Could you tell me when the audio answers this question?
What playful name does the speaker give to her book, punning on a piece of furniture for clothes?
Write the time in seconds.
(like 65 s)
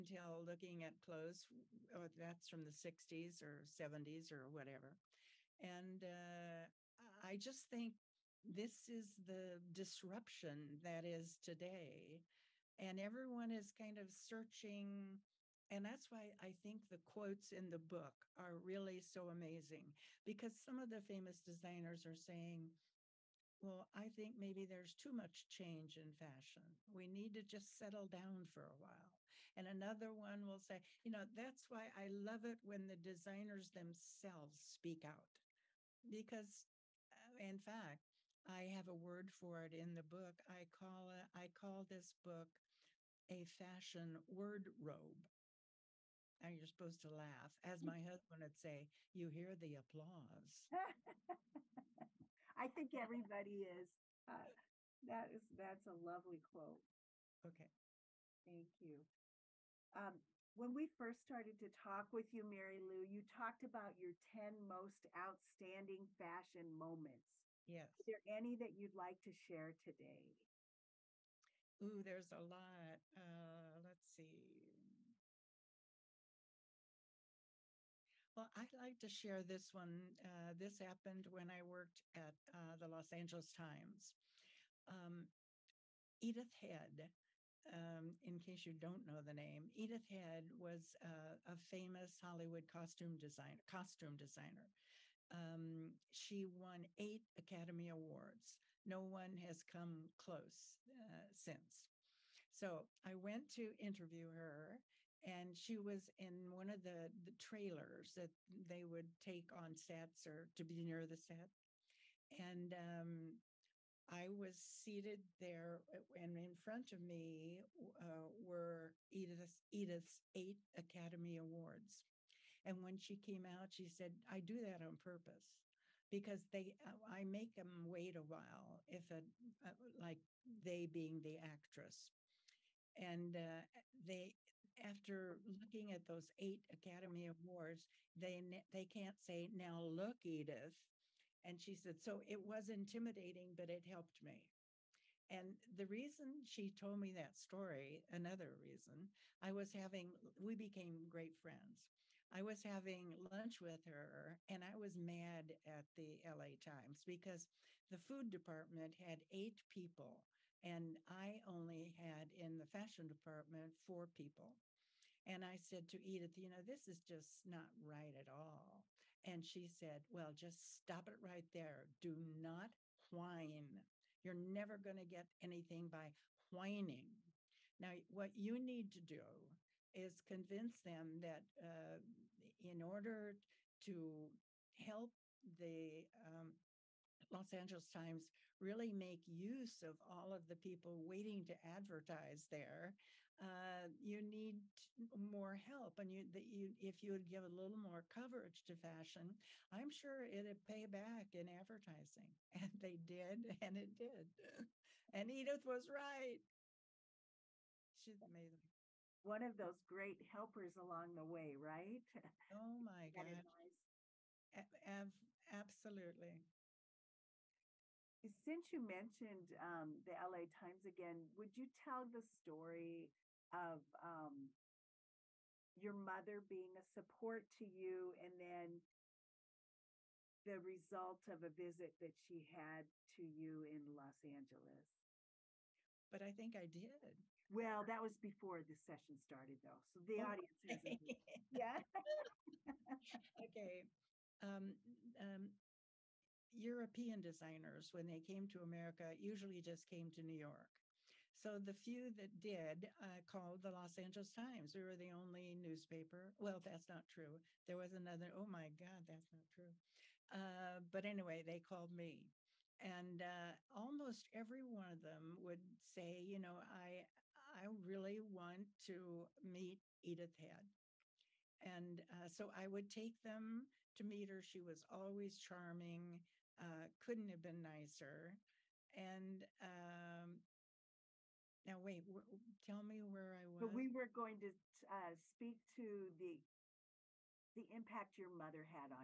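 43 s.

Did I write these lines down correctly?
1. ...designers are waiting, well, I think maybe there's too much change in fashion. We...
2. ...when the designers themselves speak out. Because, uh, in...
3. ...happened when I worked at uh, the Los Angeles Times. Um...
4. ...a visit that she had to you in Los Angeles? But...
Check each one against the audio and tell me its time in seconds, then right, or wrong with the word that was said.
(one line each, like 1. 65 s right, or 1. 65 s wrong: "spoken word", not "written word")
1. 21 s wrong: "saying", not "waiting"
2. 32 s right
3. 80 s right
4. 231 s right.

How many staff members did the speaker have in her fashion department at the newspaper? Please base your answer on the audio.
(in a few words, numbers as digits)
4.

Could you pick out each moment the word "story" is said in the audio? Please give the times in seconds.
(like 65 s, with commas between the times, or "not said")
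147 s, 222 s.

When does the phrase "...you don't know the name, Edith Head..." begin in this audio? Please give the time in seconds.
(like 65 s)
88 s.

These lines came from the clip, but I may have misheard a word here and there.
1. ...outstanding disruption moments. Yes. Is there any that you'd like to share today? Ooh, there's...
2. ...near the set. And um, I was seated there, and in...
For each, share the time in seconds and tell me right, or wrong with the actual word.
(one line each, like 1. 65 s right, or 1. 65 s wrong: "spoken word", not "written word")
1. 65 s wrong: "fashion", not "disruption"
2. 110 s right.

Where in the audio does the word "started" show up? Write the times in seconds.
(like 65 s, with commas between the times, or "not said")
61 s, 239 s.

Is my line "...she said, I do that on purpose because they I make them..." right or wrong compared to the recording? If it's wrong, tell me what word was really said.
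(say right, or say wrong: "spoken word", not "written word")
right.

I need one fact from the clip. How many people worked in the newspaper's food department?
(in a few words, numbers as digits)
8.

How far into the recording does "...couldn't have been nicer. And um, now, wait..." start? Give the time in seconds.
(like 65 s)
276 s.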